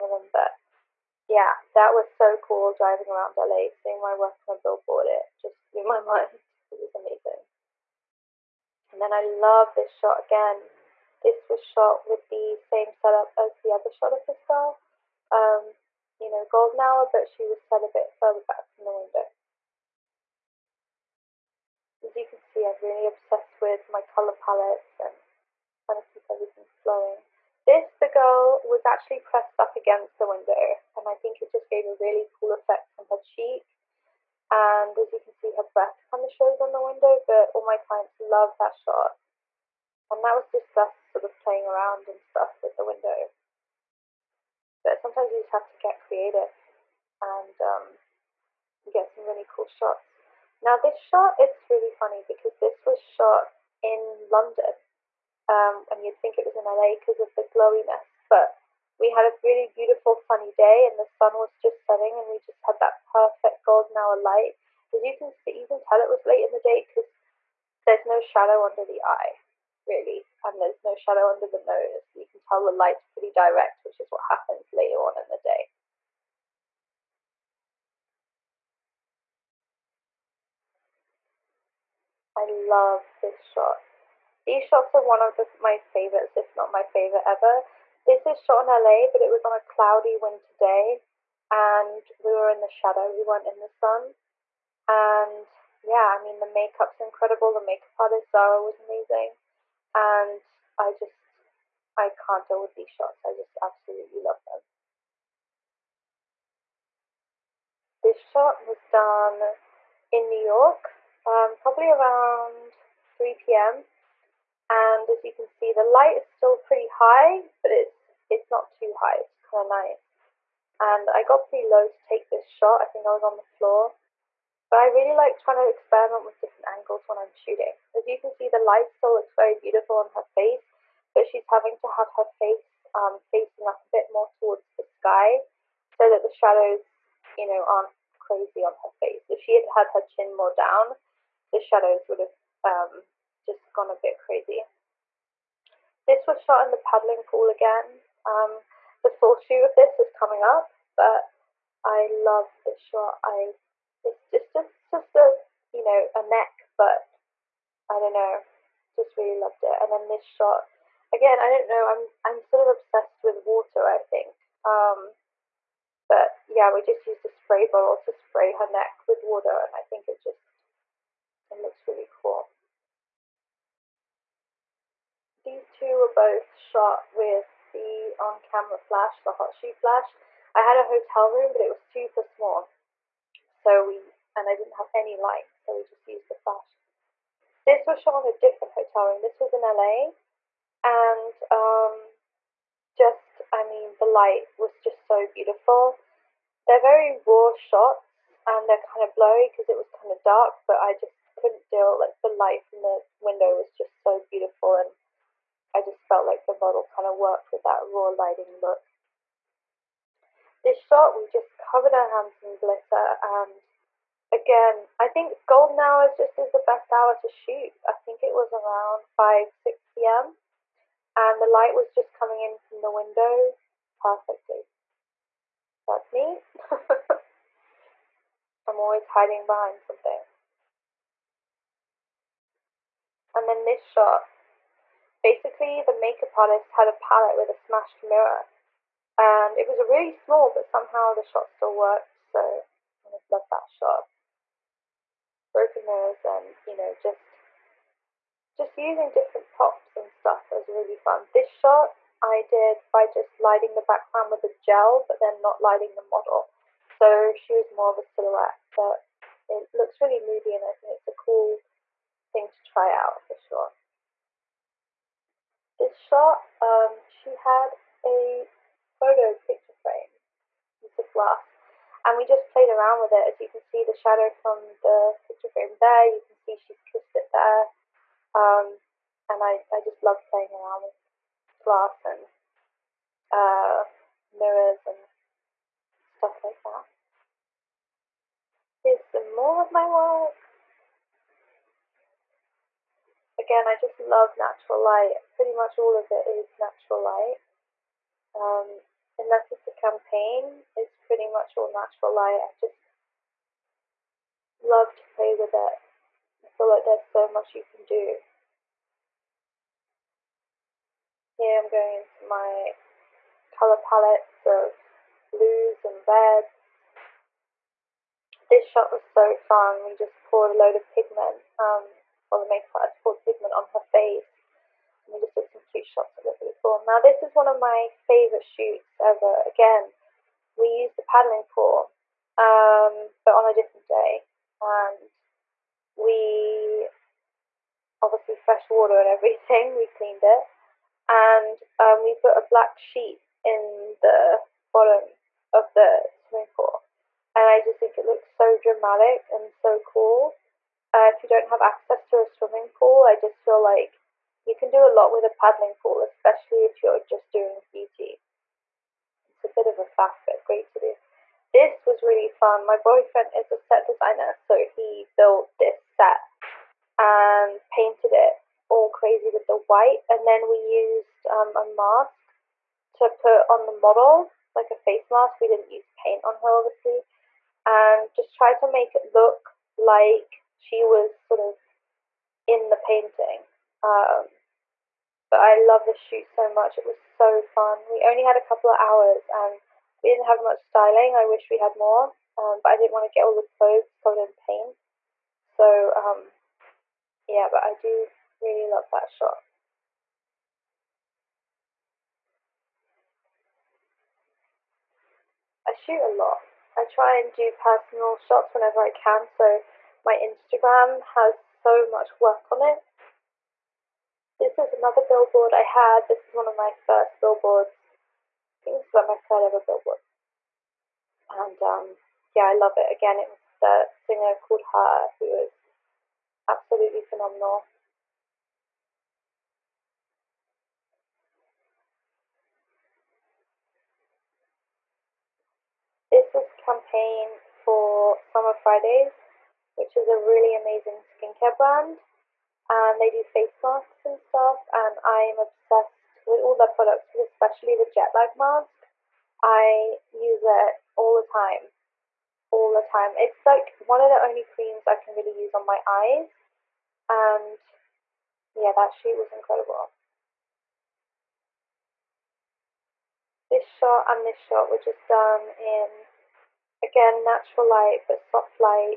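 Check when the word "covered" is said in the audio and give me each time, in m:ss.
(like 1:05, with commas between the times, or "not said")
3:31, 6:34.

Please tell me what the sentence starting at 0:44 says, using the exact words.
But sometimes you just have to get creative and um, get some really cool shots.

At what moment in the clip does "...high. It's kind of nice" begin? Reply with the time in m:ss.
1:58.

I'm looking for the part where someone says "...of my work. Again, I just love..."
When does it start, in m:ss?
4:49.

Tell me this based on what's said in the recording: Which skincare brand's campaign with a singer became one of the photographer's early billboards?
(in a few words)
Summer Fridays.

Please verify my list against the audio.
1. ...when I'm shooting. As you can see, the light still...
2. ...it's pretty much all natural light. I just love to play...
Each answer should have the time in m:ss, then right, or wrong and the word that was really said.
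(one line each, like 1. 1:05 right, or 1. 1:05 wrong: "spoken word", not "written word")
1. 2:07 right
2. 5:00 right.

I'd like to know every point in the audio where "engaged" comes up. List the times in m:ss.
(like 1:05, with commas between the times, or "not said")
not said.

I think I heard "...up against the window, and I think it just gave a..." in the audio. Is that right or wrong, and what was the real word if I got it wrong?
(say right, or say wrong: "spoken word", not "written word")
right.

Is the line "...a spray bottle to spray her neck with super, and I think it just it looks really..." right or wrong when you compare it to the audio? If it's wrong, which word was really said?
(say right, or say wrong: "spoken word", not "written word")
wrong: "water", not "super".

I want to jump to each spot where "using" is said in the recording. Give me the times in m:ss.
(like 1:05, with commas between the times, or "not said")
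4:08.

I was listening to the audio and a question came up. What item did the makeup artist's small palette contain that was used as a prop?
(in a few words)
Smashed mirror.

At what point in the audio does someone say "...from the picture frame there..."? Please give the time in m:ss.
4:34.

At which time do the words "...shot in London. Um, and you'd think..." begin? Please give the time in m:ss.
0:53.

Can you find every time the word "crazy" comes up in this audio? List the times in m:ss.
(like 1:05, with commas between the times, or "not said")
2:18, 2:24, 6:08.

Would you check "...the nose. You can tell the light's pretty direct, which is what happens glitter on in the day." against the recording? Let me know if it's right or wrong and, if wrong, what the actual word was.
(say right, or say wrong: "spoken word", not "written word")
wrong: "later", not "glitter".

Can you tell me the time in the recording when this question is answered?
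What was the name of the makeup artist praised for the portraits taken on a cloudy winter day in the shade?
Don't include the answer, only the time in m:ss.
1:38.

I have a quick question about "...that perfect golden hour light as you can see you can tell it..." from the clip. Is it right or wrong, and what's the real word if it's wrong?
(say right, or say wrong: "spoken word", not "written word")
right.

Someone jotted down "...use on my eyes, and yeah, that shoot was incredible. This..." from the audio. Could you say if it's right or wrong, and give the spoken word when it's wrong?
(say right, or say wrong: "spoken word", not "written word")
right.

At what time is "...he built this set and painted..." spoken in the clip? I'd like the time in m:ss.
6:04.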